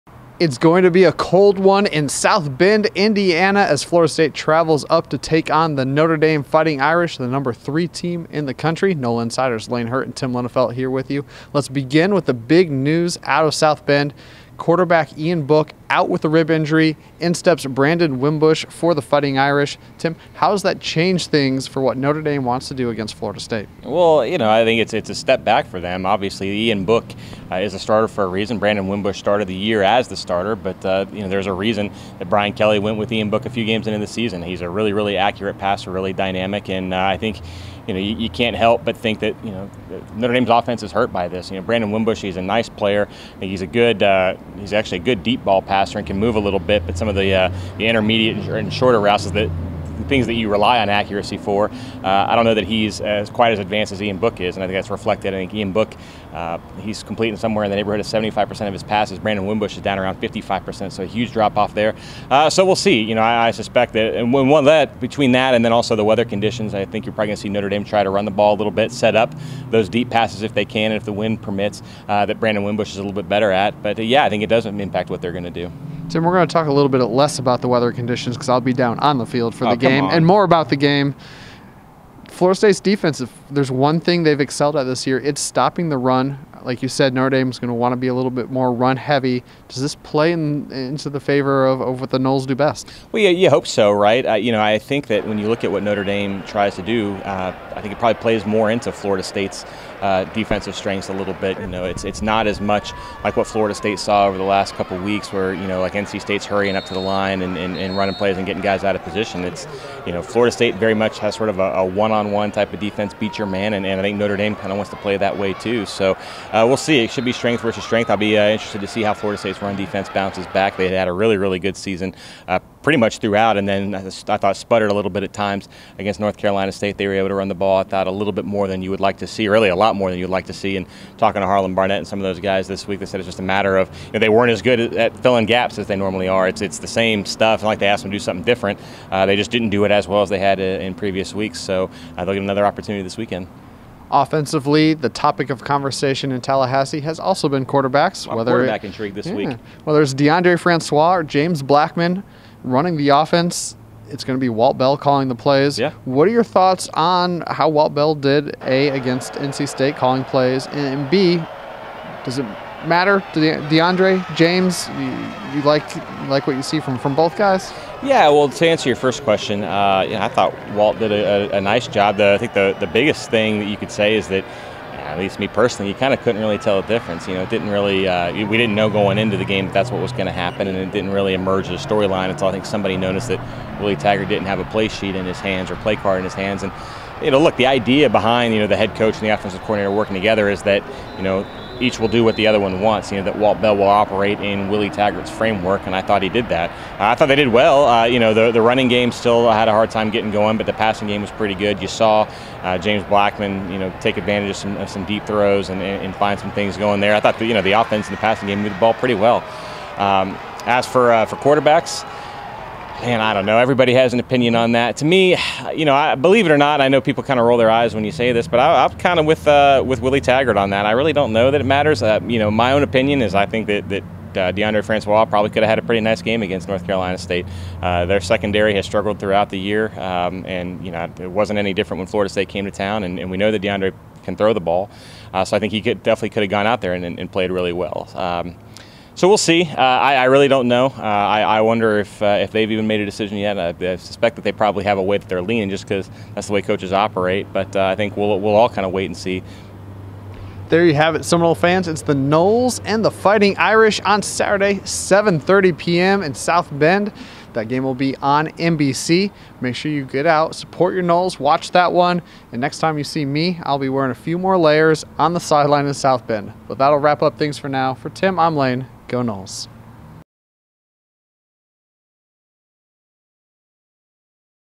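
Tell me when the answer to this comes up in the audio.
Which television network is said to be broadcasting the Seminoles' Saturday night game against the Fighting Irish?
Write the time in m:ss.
4:18.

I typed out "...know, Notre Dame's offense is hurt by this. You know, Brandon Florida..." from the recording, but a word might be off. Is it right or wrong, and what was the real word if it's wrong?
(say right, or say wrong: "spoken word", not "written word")
wrong: "Wimbush", not "Florida".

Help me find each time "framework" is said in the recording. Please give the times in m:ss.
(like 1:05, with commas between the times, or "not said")
3:15.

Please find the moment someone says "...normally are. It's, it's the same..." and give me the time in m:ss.
2:15.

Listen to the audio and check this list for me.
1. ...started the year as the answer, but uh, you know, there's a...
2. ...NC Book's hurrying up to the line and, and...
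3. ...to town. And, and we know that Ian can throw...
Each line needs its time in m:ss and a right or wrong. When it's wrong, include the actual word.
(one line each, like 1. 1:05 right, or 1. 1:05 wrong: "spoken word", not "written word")
1. 0:29 wrong: "starter", not "answer"
2. 1:45 wrong: "State", not "Book"
3. 3:52 wrong: "DeAndre", not "Ian".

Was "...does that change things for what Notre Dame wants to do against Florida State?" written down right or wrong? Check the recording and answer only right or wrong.
right.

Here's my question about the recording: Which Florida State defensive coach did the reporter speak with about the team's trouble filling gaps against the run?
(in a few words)
Harlon Barnett.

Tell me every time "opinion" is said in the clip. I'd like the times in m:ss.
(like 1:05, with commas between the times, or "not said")
3:34, 3:42.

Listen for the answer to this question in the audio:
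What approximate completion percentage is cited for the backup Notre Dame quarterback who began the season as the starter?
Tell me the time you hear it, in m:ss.
1:00.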